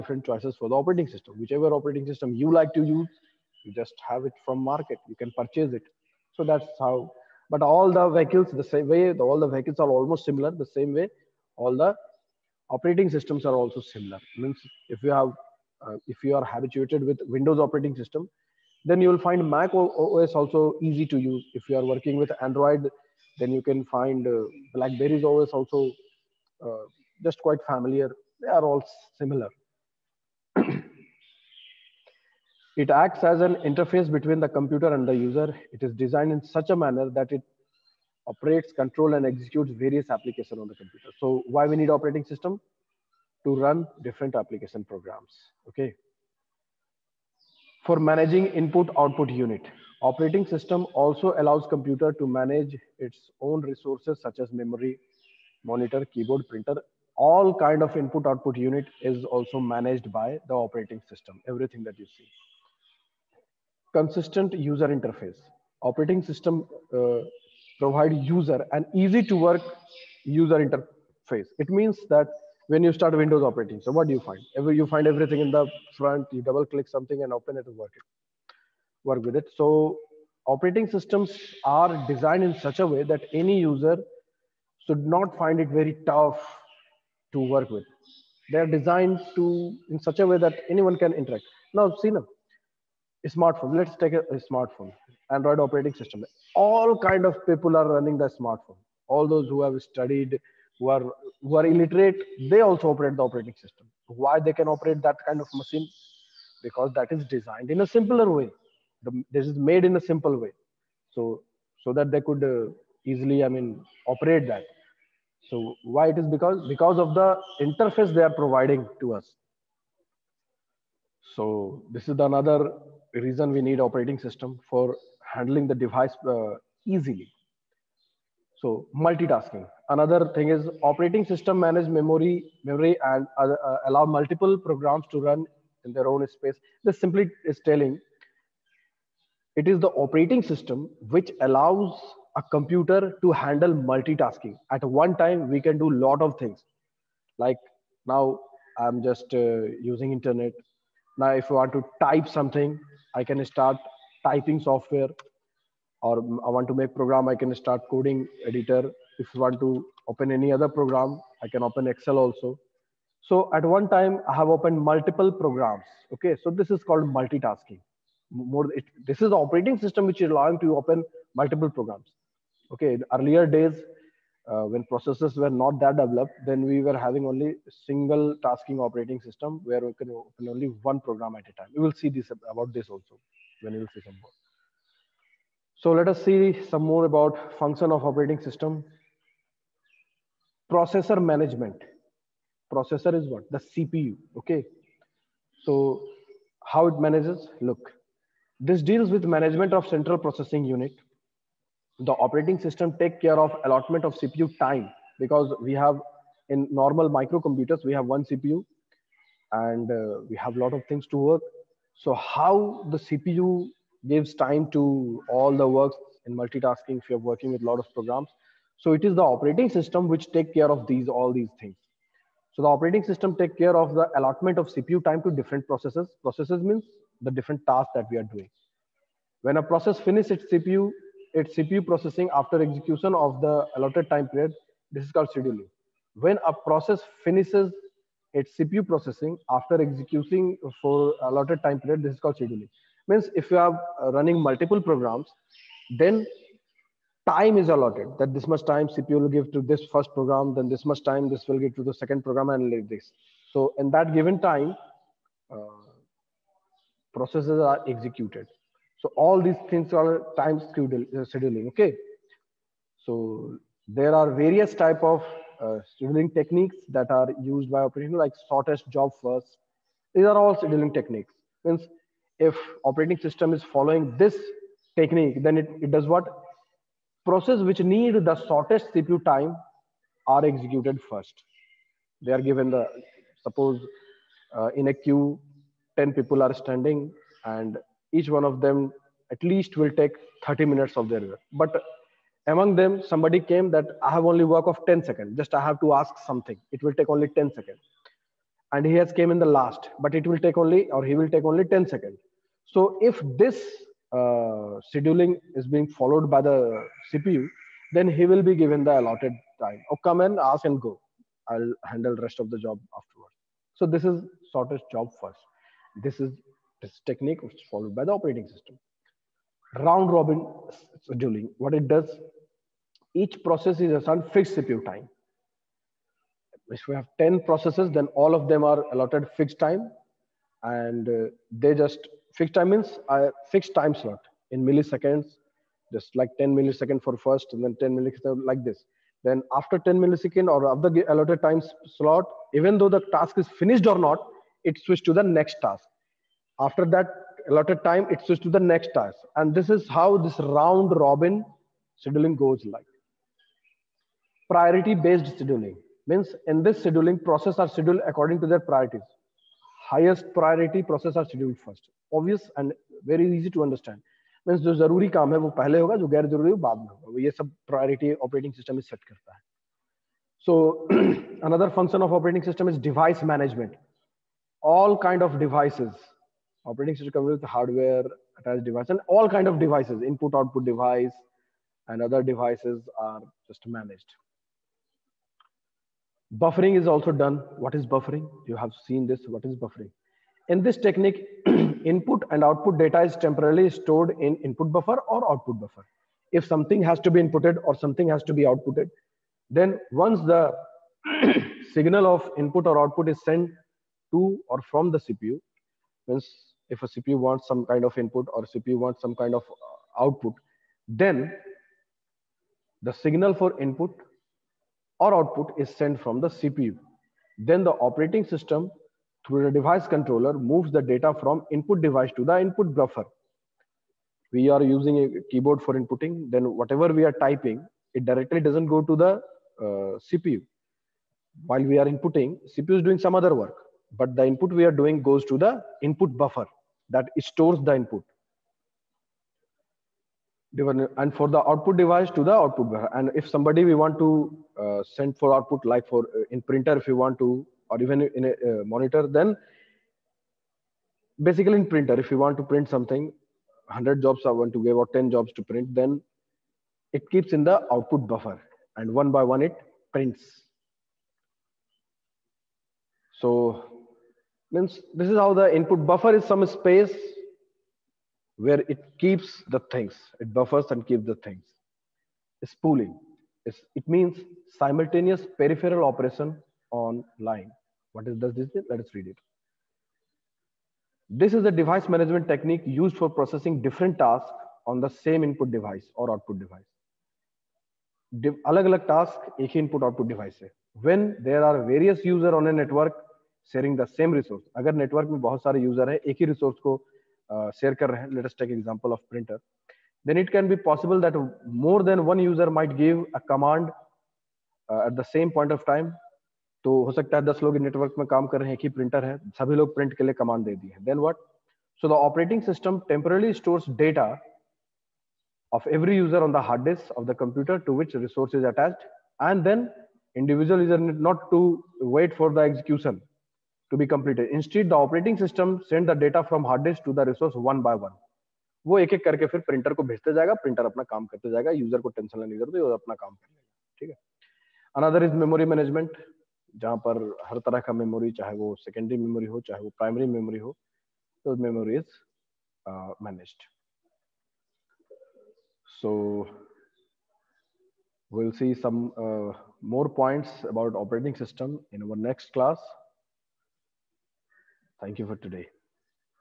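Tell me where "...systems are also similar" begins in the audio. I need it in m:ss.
0:13.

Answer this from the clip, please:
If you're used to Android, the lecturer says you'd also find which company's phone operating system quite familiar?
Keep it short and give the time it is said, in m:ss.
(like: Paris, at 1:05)
BlackBerry, at 0:24.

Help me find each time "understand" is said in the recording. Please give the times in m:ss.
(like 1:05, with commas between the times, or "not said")
6:03.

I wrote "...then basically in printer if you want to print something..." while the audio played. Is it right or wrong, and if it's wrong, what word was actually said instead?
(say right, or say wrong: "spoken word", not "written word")
right.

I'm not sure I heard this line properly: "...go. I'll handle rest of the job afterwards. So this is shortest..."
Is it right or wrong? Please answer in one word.
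right.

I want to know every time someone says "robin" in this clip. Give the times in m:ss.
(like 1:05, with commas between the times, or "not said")
5:20, 5:50.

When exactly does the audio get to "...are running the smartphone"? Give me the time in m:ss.
1:37.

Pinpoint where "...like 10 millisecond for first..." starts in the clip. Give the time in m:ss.
5:36.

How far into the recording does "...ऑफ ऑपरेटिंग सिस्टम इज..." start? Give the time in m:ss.
6:12.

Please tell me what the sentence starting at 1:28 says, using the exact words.
They're designed to in such a way that anyone can interact.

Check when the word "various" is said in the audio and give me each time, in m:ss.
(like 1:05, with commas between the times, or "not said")
0:39, 4:24.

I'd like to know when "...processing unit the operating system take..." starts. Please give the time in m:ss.
3:20.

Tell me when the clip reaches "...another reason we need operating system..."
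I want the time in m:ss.
2:02.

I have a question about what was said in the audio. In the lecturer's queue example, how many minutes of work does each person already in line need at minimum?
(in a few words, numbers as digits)
30 minutes.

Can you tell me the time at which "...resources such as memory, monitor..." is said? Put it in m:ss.
0:53.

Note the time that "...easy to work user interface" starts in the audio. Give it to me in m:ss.
1:08.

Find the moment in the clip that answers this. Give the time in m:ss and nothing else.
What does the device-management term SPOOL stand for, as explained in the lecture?
7:54.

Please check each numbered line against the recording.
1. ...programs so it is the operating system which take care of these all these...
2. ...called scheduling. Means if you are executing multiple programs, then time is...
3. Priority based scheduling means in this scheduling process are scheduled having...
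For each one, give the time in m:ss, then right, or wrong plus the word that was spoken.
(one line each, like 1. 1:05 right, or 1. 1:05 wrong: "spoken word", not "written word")
1. 3:37 right
2. 4:02 wrong: "running", not "executing"
3. 5:54 wrong: "according", not "having".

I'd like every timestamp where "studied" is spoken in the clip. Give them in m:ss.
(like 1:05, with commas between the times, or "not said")
1:39.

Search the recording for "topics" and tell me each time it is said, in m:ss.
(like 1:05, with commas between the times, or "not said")
not said.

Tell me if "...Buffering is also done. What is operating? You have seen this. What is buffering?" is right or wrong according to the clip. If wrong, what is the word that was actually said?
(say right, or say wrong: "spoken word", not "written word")
wrong: "buffering", not "operating".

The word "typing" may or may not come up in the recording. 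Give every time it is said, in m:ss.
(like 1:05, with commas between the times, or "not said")
2:34, 7:07.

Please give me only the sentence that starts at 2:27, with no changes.
Like now, I'm just uh, using internet.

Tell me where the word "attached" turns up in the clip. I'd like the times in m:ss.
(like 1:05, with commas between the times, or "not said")
6:18, 8:38.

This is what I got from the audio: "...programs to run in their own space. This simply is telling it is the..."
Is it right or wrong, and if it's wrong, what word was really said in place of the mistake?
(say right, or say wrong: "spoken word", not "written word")
right.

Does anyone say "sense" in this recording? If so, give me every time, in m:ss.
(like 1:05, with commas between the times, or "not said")
not said.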